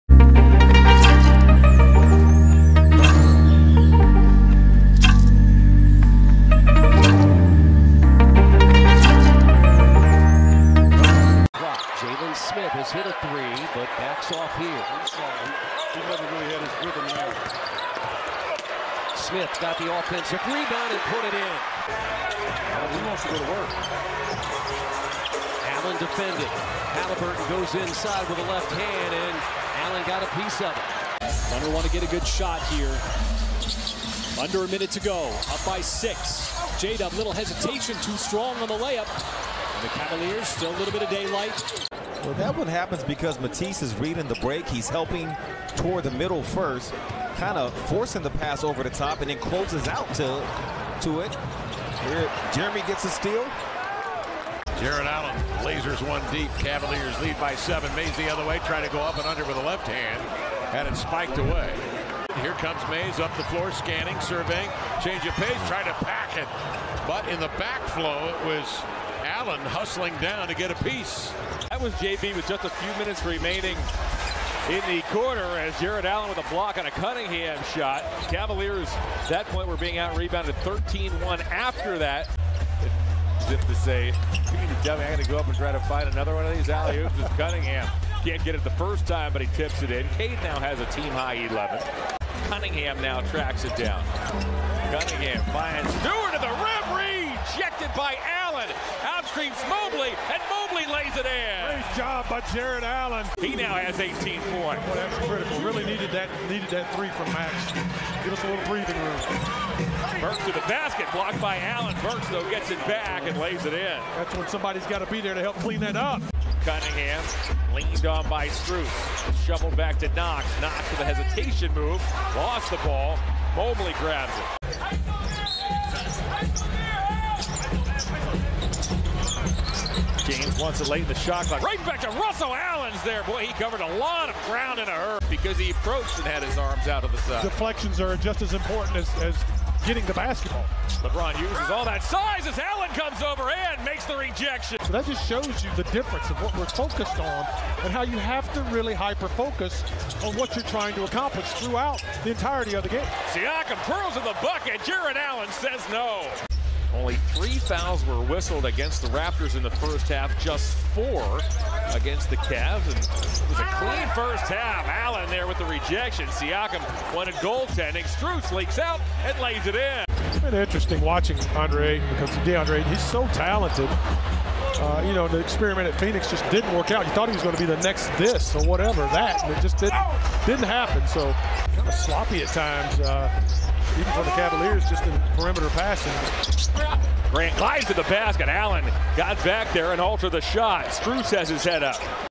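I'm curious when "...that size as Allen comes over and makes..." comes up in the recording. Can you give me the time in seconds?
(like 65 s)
141 s.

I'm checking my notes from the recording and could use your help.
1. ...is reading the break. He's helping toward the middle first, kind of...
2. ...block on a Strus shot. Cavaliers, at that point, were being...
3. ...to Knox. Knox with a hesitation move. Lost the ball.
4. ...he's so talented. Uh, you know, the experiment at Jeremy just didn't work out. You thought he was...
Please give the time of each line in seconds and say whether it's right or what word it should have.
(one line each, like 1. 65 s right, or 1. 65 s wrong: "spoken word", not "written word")
1. 43 s right
2. 76 s wrong: "Cunningham", not "Strus"
3. 119 s right
4. 172 s wrong: "Phoenix", not "Jeremy".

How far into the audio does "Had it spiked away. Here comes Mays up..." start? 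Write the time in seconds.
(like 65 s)
60 s.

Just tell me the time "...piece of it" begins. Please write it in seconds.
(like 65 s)
30 s.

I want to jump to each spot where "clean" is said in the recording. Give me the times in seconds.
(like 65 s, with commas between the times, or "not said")
115 s, 163 s.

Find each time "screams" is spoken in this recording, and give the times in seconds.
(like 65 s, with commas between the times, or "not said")
99 s.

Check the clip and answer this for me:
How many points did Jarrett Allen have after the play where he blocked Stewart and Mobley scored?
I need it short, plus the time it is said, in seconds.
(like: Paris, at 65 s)
18, at 103 s.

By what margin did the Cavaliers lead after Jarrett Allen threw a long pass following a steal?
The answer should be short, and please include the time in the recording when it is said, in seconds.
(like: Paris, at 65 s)
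7, at 57 s.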